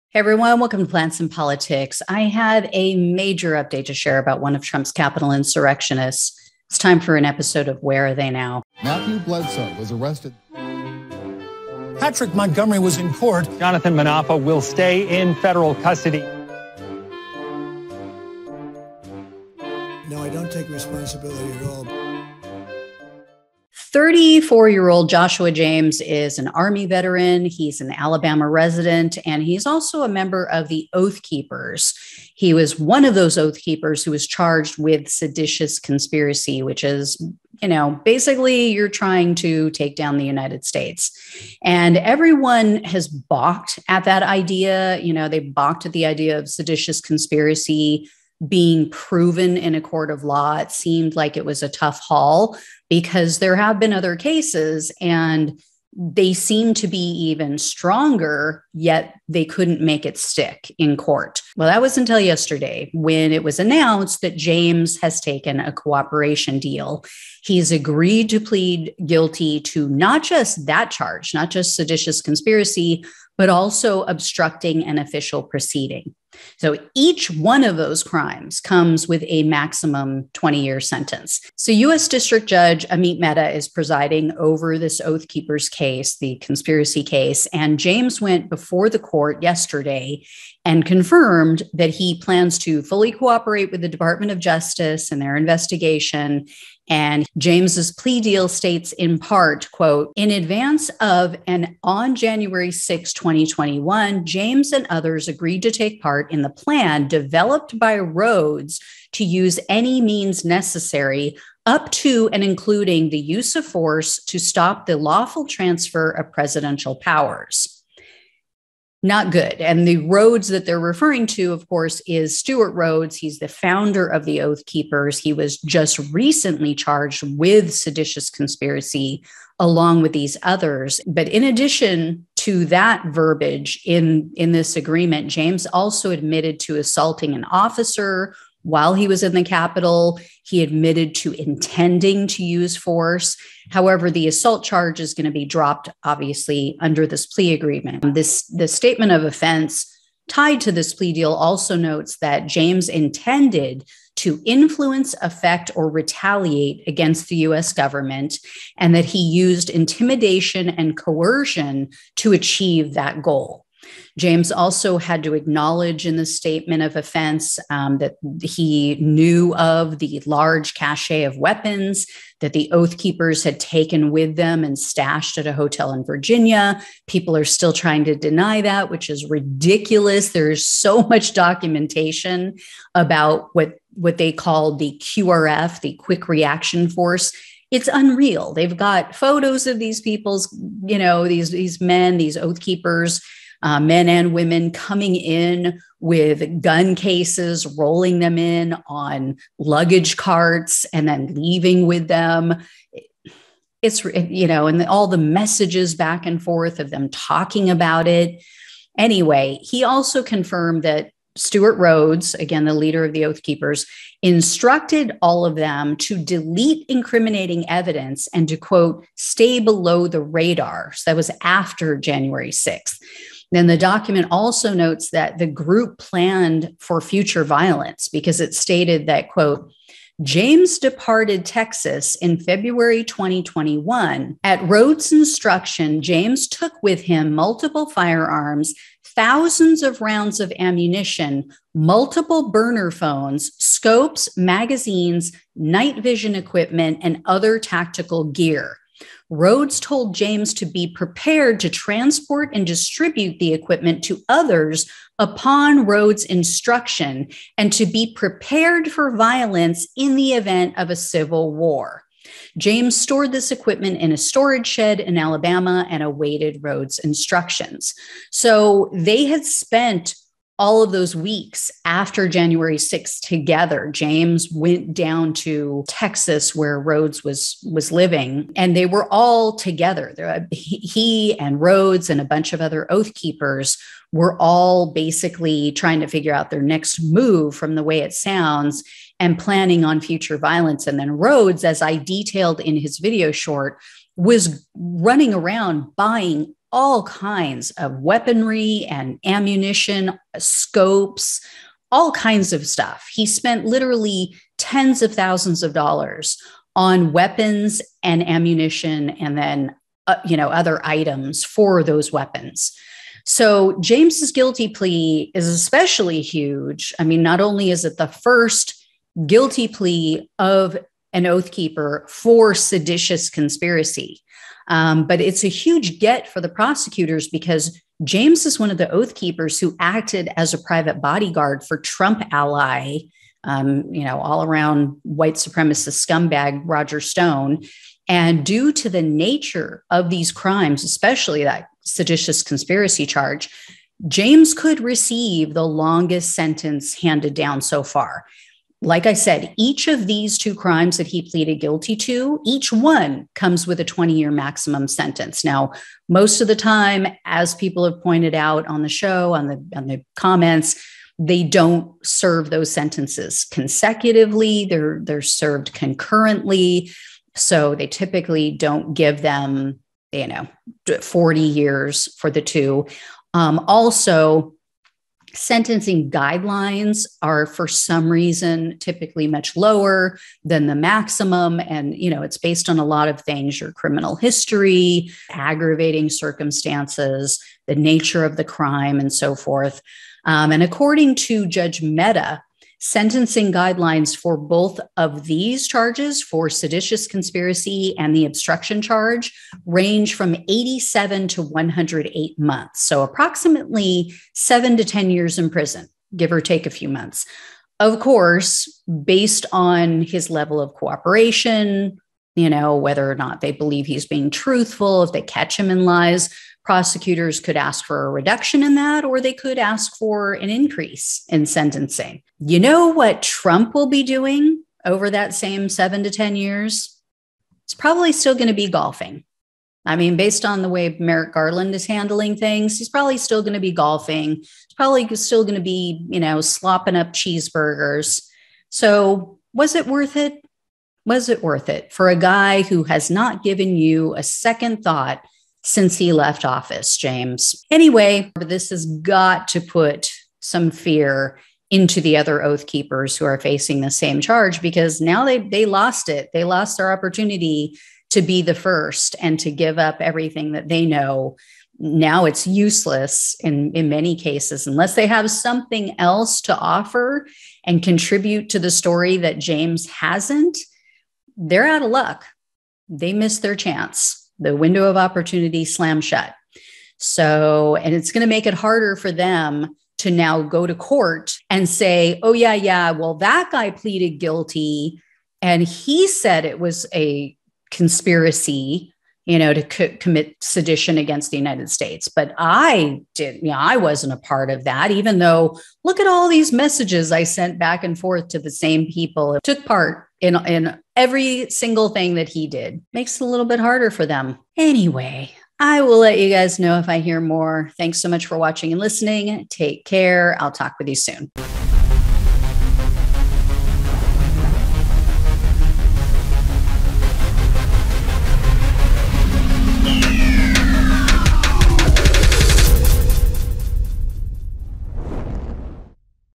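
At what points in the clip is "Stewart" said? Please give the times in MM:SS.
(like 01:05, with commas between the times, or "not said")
02:02, 03:31.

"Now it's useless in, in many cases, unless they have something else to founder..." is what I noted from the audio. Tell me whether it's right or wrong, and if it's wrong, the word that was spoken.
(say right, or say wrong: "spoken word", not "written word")
wrong: "offer", not "founder".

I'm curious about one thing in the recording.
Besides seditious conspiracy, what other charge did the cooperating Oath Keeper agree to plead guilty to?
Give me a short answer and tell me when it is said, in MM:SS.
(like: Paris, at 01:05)
Obstructing an official proceeding, at 01:14.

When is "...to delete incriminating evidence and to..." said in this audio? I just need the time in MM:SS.
03:35.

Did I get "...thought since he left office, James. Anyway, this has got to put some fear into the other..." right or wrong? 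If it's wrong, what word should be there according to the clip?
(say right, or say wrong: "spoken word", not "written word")
right.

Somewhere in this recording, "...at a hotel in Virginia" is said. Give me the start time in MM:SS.
02:55.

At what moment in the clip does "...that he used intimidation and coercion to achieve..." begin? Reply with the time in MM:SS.
02:38.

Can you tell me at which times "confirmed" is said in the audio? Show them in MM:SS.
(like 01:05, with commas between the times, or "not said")
01:30, 03:30.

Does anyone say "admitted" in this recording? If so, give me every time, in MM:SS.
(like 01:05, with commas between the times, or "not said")
02:16, 02:20.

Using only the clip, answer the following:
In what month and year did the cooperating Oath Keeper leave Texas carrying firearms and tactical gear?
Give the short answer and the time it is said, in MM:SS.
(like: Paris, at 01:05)
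February 2021, at 03:52.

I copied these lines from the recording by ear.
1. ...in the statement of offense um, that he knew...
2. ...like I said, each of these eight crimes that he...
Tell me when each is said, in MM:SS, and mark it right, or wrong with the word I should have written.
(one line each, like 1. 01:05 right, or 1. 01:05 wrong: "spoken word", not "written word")
1. 02:46 right
2. 05:48 wrong: "two", not "eight".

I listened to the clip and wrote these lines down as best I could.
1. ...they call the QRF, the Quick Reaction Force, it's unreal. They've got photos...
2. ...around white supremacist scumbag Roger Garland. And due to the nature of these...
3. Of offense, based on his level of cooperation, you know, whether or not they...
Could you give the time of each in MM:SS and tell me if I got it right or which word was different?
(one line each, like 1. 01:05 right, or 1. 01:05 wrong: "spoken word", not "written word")
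1. 03:04 right
2. 05:34 wrong: "Stone", not "Garland"
3. 06:47 wrong: "course", not "offense".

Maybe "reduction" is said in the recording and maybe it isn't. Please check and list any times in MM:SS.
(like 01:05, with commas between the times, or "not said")
06:58.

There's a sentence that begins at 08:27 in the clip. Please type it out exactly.
Thanks so much for watching and listening.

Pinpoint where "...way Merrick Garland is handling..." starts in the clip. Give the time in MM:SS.
07:10.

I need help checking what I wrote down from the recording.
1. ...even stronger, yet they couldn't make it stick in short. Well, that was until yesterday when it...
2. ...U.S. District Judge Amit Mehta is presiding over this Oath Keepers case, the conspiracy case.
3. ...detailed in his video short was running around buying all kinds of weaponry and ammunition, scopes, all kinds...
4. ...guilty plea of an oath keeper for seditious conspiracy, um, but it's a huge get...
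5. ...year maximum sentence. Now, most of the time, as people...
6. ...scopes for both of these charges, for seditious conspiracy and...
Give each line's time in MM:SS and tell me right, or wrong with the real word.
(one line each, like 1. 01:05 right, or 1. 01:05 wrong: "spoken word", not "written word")
1. 00:56 wrong: "court", not "short"
2. 01:21 right
3. 04:51 right
4. 05:19 right
5. 05:54 right
6. 06:33 wrong: "guidelines", not "scopes".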